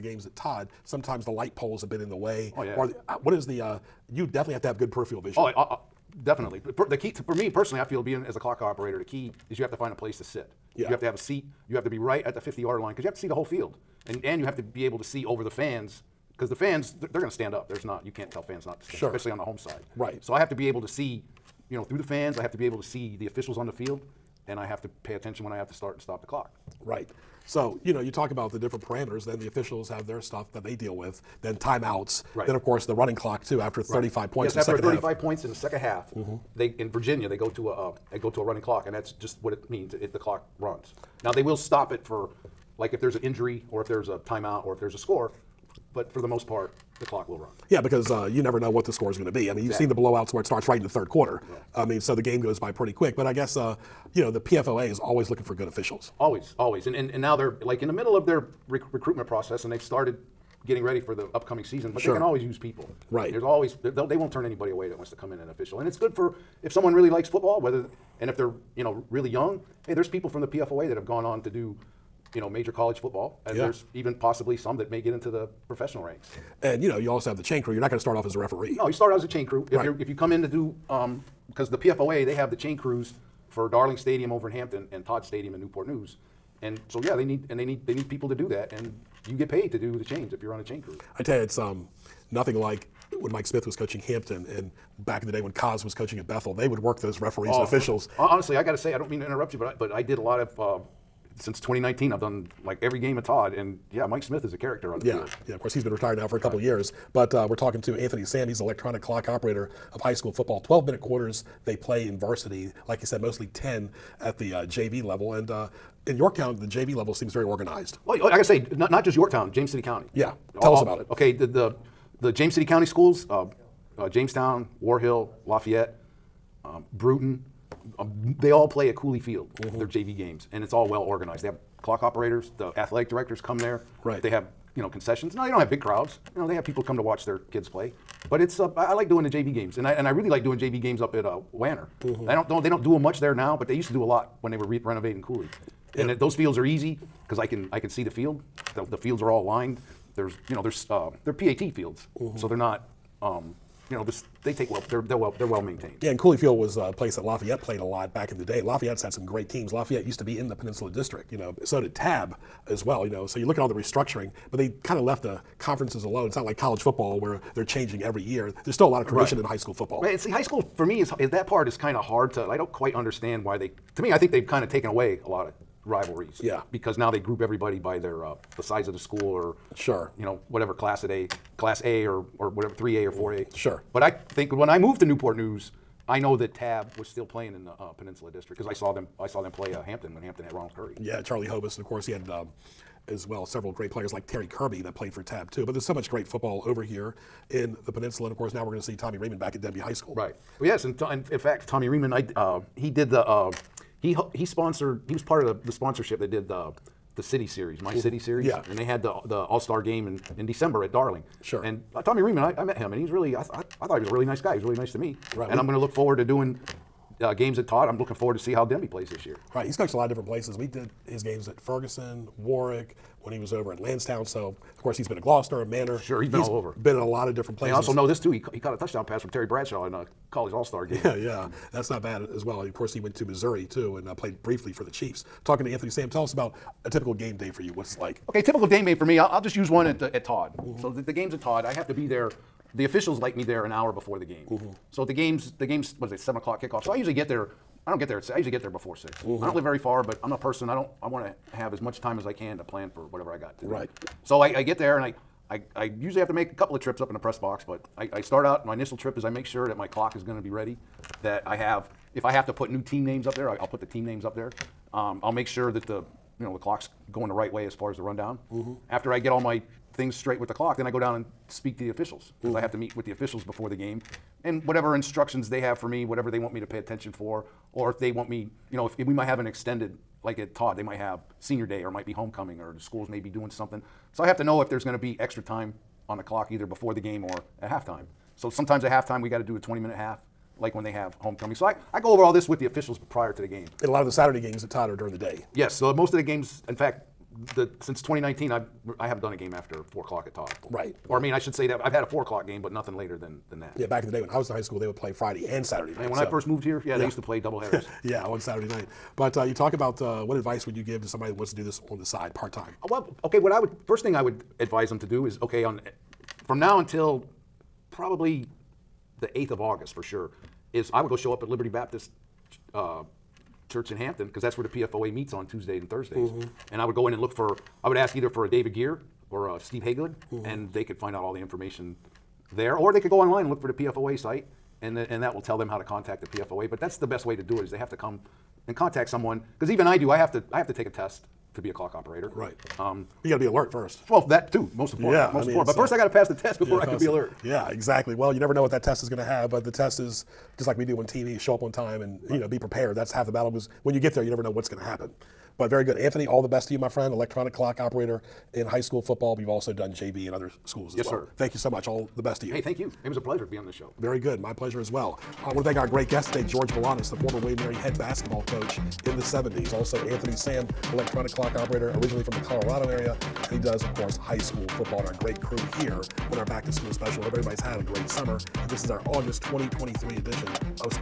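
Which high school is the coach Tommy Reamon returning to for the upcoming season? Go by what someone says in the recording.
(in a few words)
Denbigh High School.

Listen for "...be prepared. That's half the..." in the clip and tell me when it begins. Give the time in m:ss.
5:52.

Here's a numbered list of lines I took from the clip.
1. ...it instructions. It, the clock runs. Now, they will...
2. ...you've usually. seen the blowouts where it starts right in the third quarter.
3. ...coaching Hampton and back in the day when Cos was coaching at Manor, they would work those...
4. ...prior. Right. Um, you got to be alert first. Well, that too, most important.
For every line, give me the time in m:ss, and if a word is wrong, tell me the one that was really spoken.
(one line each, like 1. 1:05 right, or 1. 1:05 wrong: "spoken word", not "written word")
1. 0:39 wrong: "means", not "instructions"
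2. 0:49 wrong: "exactly", not "usually"
3. 1:33 wrong: "Bethel", not "Manor"
4. 5:41 wrong: "operator", not "prior".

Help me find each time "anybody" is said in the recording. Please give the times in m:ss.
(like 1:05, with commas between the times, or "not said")
1:04.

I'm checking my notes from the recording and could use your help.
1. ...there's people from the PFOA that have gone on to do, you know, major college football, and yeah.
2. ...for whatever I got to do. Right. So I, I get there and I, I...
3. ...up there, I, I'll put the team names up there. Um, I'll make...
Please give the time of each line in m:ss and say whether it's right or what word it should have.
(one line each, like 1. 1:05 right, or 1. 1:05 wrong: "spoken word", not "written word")
1. 1:09 right
2. 4:12 right
3. 4:23 right.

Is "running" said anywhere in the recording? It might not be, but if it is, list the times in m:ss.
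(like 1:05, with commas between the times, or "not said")
0:32, 0:38.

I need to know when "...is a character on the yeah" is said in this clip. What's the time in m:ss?
1:44.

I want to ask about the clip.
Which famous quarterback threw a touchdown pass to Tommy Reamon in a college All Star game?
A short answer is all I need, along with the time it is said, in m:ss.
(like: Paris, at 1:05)
Terry Bradshaw, at 3:49.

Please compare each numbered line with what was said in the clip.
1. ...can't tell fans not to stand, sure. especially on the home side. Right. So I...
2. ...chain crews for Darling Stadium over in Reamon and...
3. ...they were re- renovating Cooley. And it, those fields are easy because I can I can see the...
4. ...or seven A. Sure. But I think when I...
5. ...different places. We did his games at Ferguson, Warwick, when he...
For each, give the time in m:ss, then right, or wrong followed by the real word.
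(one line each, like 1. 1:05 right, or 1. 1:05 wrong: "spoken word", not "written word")
1. 0:18 right
2. 1:22 wrong: "Hampton", not "Reamon"
3. 2:24 right
4. 3:03 wrong: "four", not "seven"
5. 3:40 right.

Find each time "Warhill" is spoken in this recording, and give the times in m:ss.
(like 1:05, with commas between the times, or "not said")
2:04.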